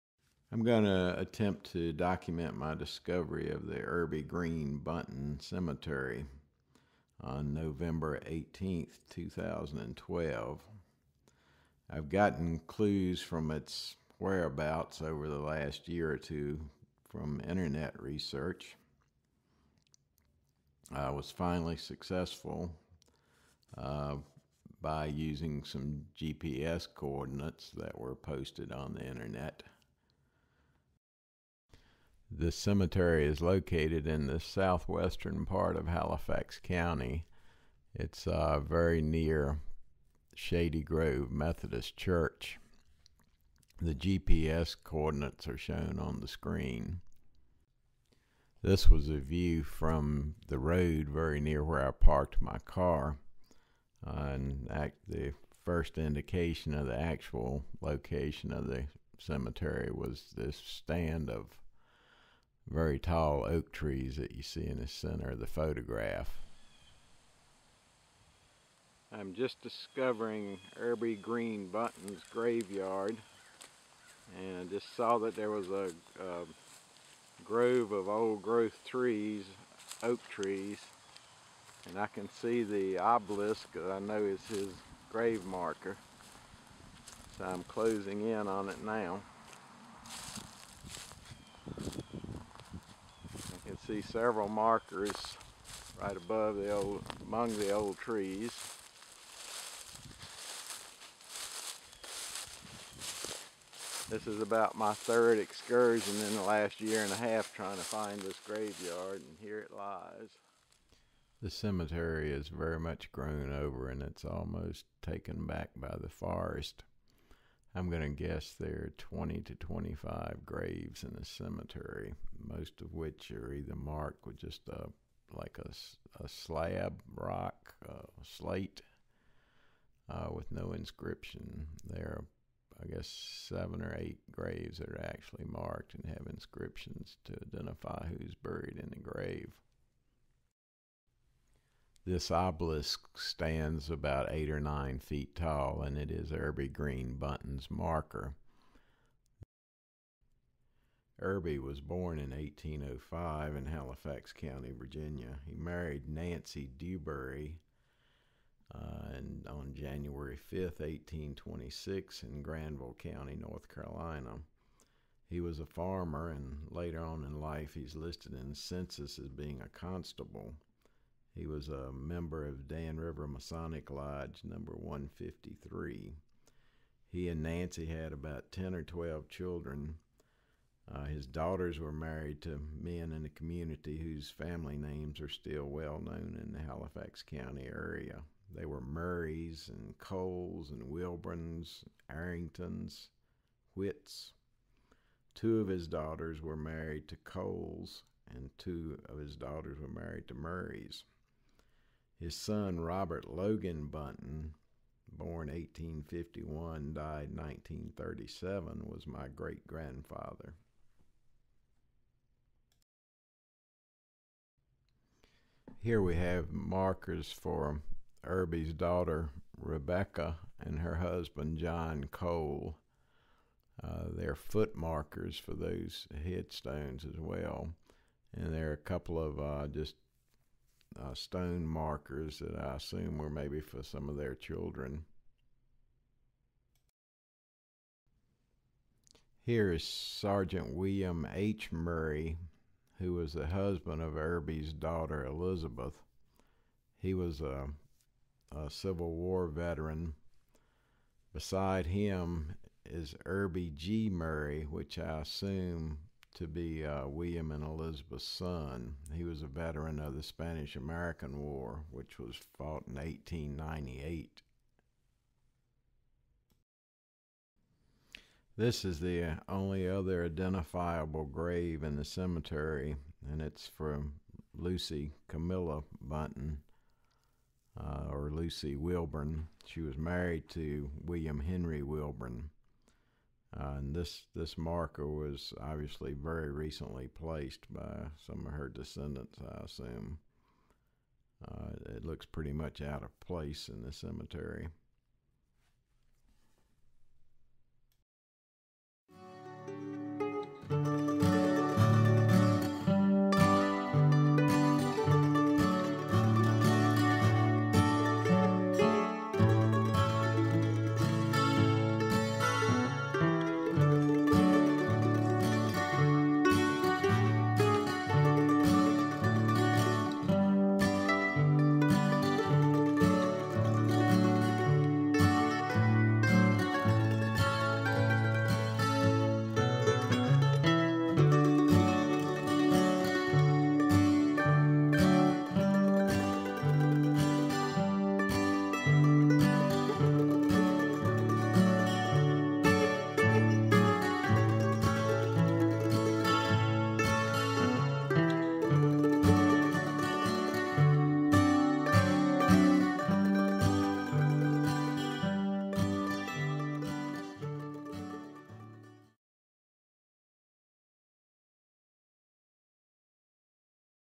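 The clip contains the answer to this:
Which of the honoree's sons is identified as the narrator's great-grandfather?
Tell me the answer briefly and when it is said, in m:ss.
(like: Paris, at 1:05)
Robert Logan Buntin, at 3:22.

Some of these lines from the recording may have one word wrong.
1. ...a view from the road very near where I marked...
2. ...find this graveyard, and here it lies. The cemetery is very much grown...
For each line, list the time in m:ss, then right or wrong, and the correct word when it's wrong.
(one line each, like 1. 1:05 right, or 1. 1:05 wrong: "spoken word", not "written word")
1. 0:49 wrong: "parked", not "marked"
2. 1:47 right.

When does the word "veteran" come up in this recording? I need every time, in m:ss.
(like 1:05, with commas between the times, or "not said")
4:09, 4:19.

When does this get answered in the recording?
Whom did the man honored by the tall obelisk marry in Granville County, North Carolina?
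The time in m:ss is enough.
2:36.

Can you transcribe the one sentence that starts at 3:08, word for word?
They were Murrays and Coles and Wilburns, Arringtons, Whits.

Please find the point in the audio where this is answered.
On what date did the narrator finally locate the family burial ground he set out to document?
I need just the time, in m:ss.
0:07.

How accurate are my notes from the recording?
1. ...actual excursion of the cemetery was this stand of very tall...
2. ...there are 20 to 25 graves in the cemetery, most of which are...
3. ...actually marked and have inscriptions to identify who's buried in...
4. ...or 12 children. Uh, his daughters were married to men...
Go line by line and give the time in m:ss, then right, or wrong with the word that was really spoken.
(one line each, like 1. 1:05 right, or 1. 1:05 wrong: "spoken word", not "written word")
1. 0:56 wrong: "location", not "excursion"
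2. 1:58 right
3. 2:15 right
4. 2:58 right.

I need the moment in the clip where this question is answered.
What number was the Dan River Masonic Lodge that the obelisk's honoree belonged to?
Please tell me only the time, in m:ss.
2:54.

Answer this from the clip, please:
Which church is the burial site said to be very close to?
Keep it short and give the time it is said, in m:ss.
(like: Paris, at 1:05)
Shady Grove Methodist Church, at 0:40.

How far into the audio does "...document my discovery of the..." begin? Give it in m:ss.
0:01.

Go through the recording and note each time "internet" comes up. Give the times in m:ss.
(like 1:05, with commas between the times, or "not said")
0:17, 0:29.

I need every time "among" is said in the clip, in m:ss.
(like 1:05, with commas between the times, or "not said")
1:37.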